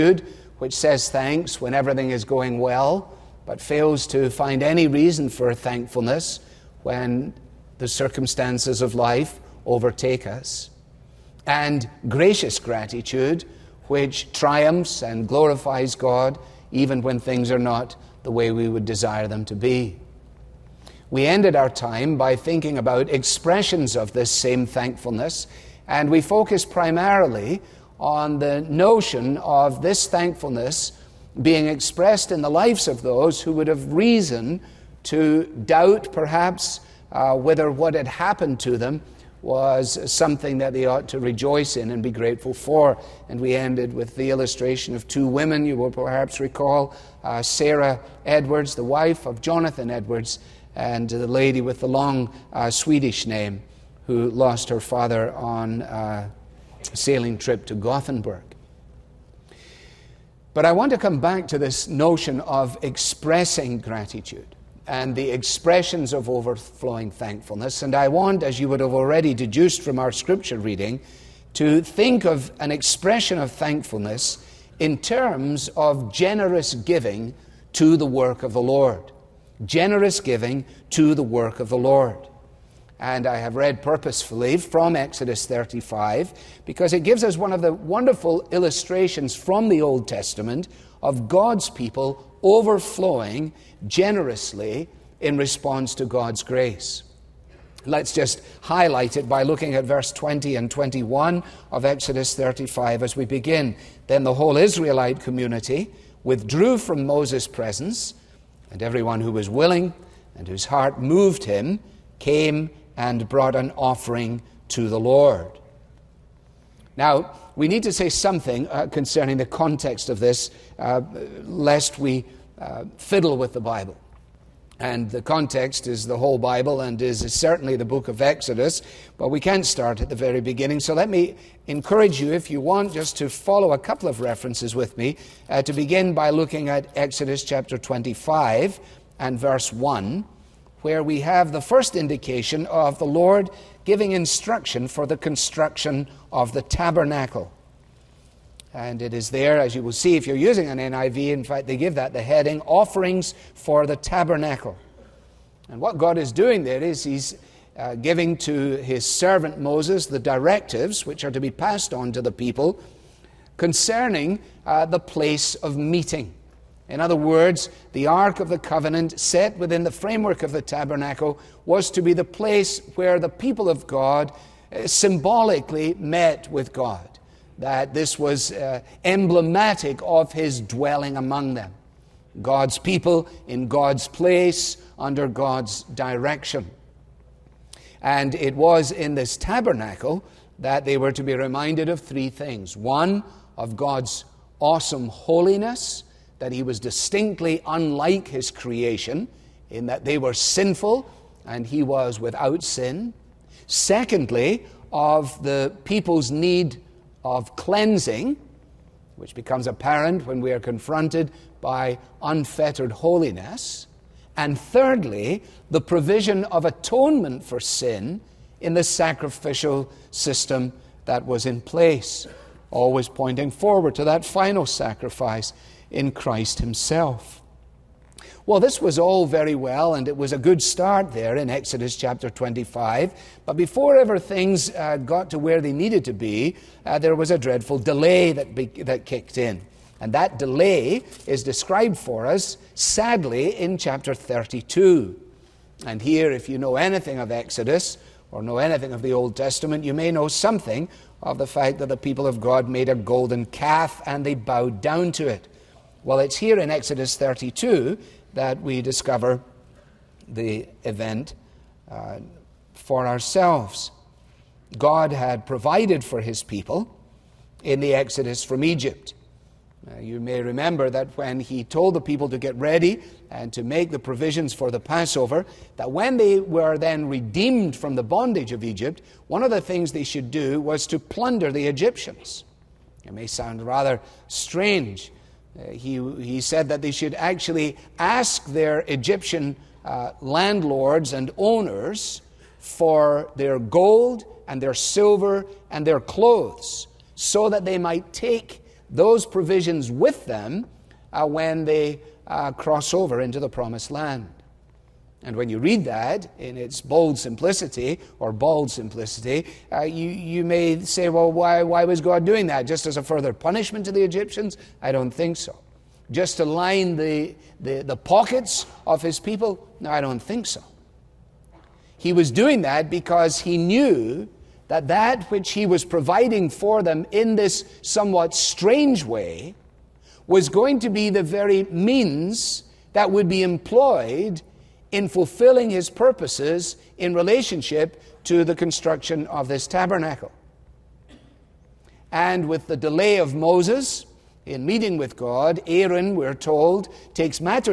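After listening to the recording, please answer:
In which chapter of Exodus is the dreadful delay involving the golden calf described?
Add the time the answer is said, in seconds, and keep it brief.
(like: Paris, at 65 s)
Chapter 32, at 243 s.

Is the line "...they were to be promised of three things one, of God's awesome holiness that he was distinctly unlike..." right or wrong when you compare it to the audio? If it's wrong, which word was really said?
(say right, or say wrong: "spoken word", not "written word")
wrong: "reminded", not "promised".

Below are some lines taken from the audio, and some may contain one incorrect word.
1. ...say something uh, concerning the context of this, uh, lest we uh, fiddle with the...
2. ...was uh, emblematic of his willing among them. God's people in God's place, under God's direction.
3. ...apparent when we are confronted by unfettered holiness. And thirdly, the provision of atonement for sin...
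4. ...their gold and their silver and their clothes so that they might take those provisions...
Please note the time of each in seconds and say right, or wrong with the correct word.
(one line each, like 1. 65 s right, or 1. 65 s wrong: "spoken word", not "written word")
1. 117 s right
2. 178 s wrong: "dwelling", not "willing"
3. 209 s right
4. 293 s right.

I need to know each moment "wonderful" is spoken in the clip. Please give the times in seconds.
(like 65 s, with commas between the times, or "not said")
87 s.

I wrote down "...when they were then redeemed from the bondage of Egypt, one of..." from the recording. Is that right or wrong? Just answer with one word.
right.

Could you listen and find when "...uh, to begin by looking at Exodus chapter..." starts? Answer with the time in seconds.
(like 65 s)
135 s.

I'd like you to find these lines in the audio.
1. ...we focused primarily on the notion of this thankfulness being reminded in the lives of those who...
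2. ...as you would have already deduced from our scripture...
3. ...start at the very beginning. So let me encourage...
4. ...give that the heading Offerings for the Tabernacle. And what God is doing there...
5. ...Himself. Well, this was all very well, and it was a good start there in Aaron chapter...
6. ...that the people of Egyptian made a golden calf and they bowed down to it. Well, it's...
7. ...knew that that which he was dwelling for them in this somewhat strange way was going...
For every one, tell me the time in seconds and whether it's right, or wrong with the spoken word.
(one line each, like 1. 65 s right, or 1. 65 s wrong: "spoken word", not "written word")
1. 26 s wrong: "expressed", not "reminded"
2. 68 s right
3. 129 s right
4. 151 s right
5. 226 s wrong: "Exodus", not "Aaron"
6. 251 s wrong: "God", not "Egyptian"
7. 323 s wrong: "providing", not "dwelling".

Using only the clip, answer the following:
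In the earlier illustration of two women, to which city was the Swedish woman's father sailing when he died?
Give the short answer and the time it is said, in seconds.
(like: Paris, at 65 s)
Gothenburg, at 57 s.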